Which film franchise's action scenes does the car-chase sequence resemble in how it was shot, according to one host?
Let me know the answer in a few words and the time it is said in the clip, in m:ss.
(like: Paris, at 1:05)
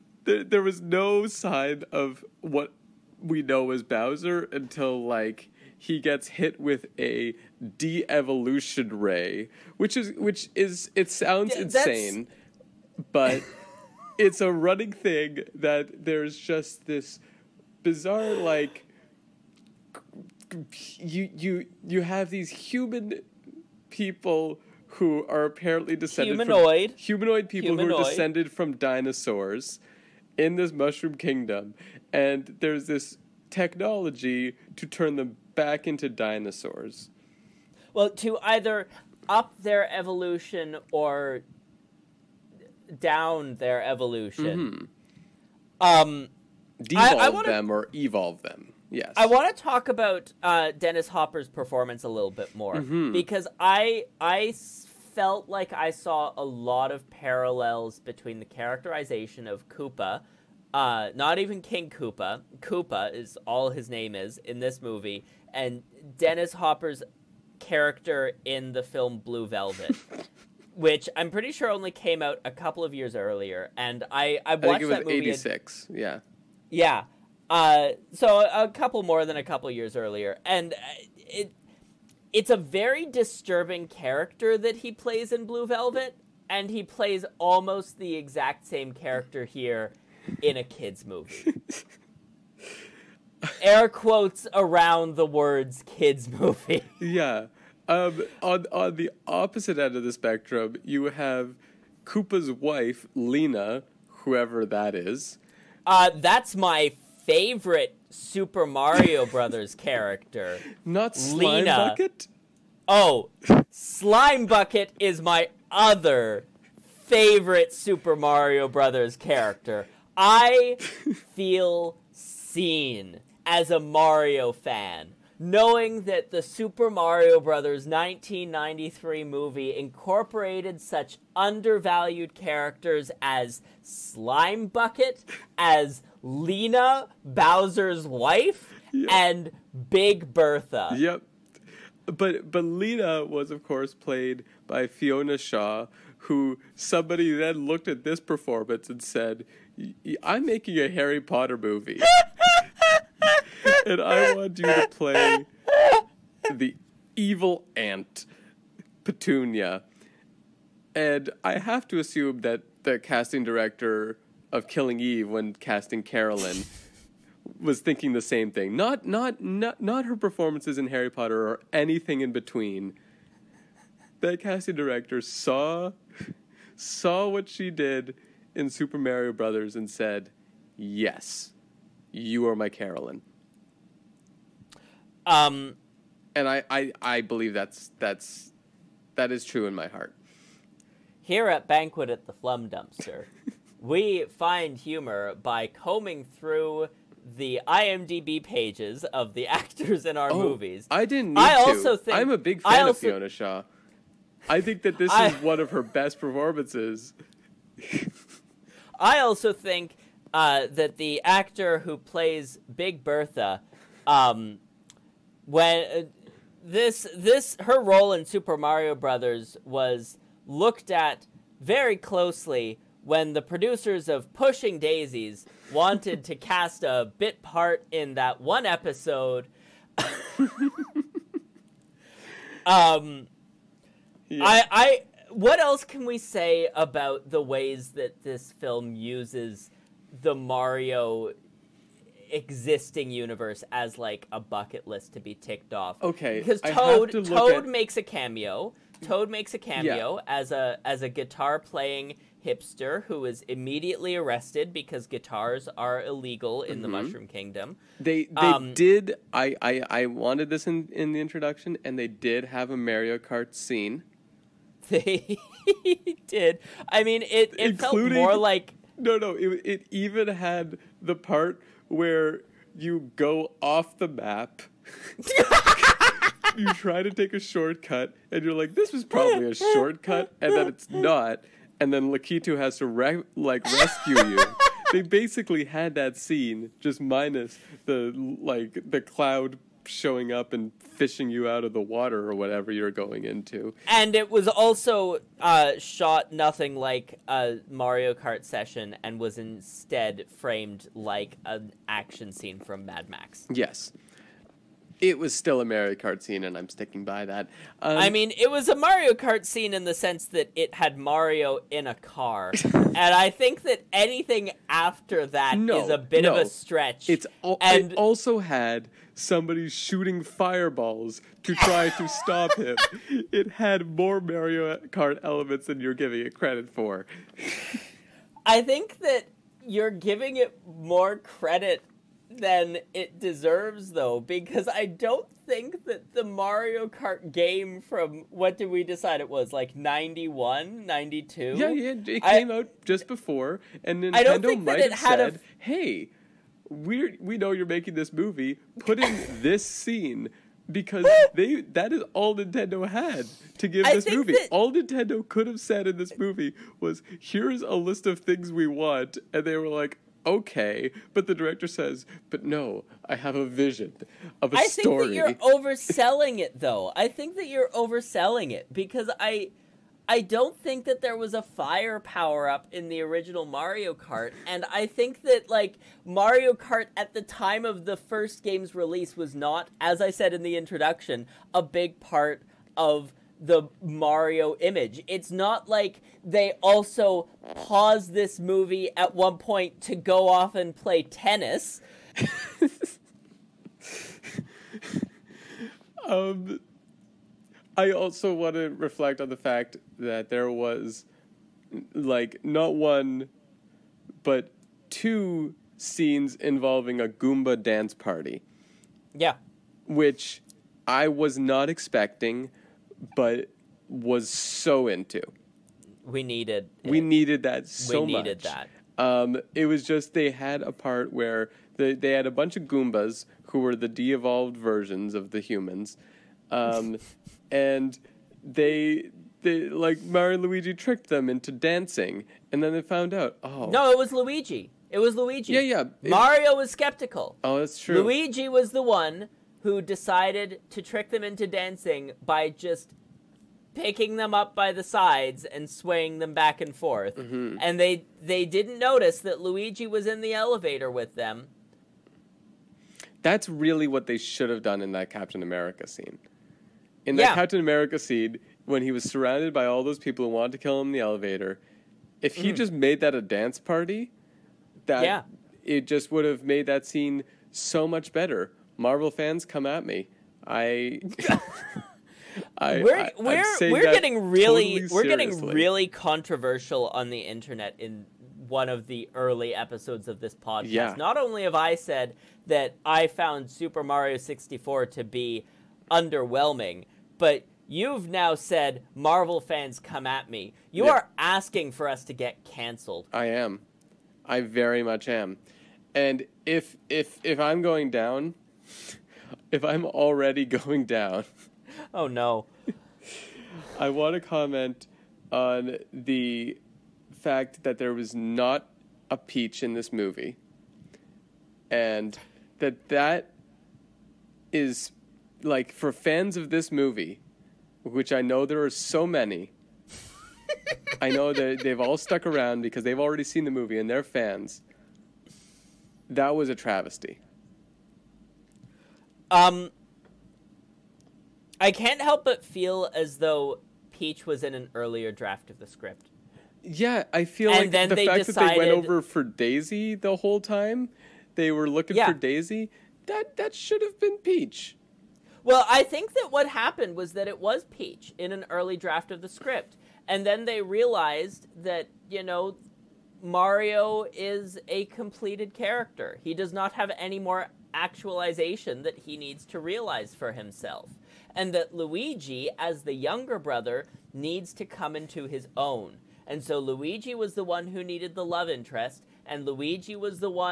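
Mad Max, at 5:02.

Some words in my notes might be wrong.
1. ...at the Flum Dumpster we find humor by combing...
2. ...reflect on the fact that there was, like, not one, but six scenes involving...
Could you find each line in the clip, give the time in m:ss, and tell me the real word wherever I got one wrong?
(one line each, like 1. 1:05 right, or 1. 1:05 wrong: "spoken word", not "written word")
1. 3:12 right
2. 6:38 wrong: "two", not "six".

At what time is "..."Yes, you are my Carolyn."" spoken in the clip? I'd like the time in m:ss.
3:00.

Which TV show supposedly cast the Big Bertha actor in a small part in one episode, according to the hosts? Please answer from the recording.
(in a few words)
Pushing Daisies.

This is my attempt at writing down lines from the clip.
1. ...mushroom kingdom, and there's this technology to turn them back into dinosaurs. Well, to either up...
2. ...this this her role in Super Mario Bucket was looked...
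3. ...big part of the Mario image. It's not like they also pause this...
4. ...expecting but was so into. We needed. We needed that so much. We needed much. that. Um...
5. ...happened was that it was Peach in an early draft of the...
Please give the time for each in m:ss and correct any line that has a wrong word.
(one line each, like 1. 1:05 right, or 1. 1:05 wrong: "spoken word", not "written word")
1. 0:30 right
2. 3:36 wrong: "Brothers", not "Bucket"
3. 6:21 right
4. 6:51 right
5. 9:06 right.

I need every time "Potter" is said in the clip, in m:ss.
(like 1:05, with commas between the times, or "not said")
2:31, 2:51.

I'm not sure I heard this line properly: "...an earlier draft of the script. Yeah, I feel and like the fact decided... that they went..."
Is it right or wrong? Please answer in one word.
right.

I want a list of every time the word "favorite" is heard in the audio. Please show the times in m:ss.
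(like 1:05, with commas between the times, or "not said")
1:47, 1:57.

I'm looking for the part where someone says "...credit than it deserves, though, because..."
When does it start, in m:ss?
5:31.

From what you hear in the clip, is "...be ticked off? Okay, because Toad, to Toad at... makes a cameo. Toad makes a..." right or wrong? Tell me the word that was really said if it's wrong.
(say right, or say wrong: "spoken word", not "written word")
right.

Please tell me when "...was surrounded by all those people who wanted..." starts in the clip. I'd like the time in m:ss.
7:38.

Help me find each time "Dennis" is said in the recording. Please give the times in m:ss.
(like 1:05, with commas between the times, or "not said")
0:50, 1:06.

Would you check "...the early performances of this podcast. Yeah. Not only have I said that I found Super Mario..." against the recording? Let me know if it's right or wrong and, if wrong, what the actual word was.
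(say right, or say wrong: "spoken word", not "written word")
wrong: "episodes", not "performances".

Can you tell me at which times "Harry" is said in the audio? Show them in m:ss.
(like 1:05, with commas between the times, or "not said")
2:30, 2:50.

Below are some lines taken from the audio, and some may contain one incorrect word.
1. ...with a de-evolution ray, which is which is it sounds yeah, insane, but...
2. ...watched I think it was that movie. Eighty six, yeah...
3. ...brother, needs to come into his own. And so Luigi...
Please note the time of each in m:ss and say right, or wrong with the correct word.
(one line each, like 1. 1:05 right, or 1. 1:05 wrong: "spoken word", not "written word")
1. 0:06 right
2. 1:14 right
3. 9:23 right.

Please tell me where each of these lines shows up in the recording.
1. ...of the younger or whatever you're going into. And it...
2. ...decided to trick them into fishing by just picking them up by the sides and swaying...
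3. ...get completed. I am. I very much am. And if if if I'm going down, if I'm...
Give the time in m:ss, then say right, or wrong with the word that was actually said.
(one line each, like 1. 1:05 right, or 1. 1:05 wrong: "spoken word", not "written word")
1. 4:51 wrong: "water", not "younger"
2. 7:19 wrong: "dancing", not "fishing"
3. 8:12 wrong: "canceled", not "completed".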